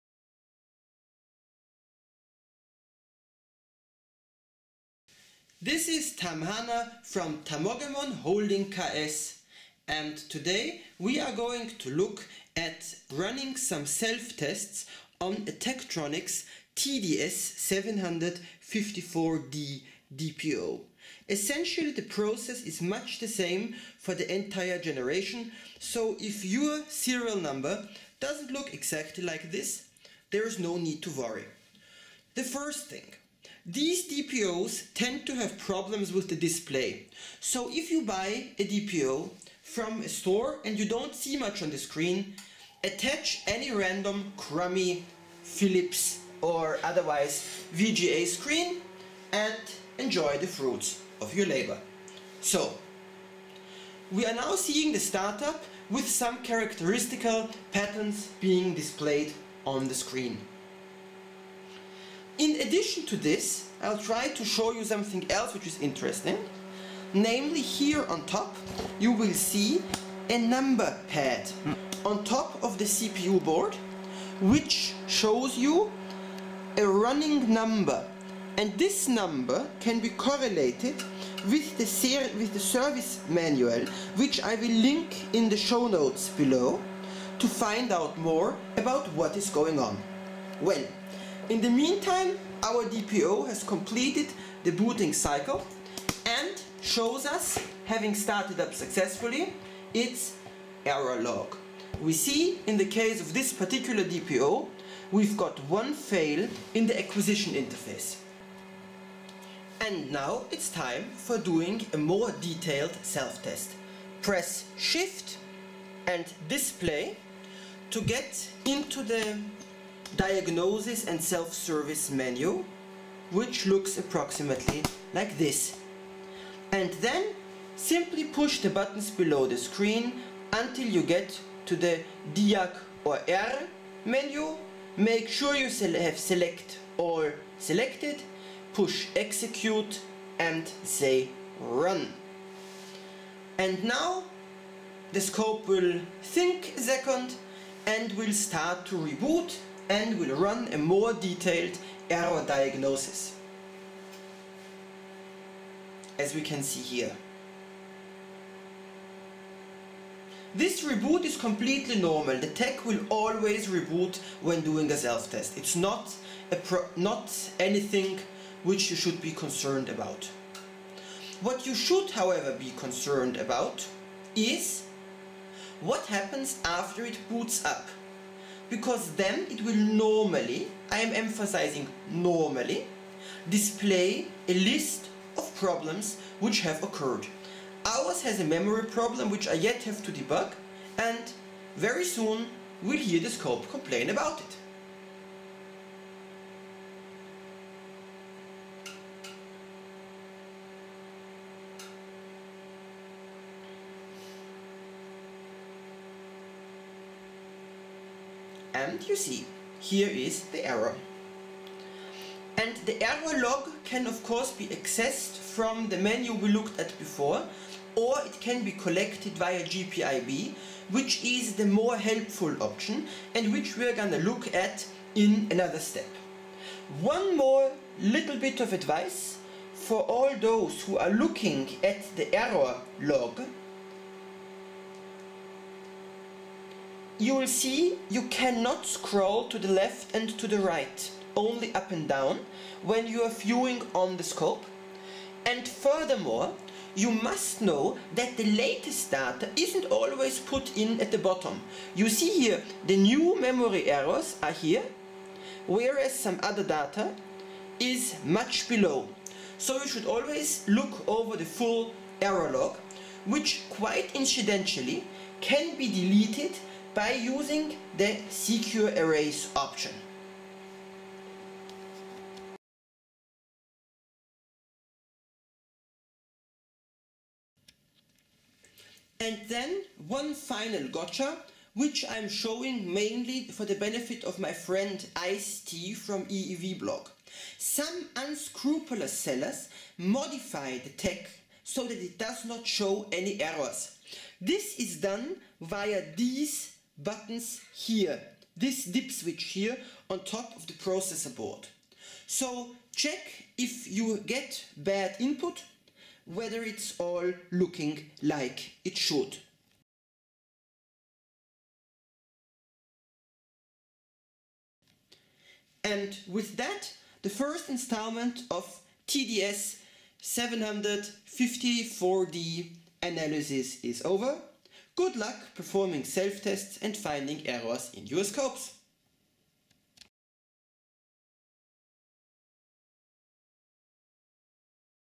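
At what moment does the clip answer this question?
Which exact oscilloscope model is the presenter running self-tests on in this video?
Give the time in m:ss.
0:15.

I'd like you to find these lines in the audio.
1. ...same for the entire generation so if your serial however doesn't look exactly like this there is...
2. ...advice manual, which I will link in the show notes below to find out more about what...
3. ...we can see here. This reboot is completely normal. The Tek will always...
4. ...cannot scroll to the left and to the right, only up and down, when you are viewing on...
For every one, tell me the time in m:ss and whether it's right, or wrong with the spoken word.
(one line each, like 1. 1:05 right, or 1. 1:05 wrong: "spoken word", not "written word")
1. 0:23 wrong: "number", not "however"
2. 1:22 wrong: "service", not "advice"
3. 2:36 right
4. 3:58 right.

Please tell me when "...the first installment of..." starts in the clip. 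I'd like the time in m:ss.
5:17.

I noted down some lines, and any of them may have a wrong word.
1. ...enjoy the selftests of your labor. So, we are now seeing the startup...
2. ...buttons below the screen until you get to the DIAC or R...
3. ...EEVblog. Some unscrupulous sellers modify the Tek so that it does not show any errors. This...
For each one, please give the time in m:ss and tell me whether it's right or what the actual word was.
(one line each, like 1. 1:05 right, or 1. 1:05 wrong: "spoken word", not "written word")
1. 0:49 wrong: "fruits", not "selftests"
2. 2:08 right
3. 4:46 right.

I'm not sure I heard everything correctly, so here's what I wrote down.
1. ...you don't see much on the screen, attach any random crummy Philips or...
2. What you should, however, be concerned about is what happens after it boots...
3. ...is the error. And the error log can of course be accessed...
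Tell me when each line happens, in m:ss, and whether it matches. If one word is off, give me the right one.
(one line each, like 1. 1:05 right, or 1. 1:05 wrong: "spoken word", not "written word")
1. 0:40 right
2. 2:51 right
3. 3:30 right.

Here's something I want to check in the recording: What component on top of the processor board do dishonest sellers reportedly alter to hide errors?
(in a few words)
dip switch.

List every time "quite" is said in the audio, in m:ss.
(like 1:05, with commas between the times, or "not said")
4:23.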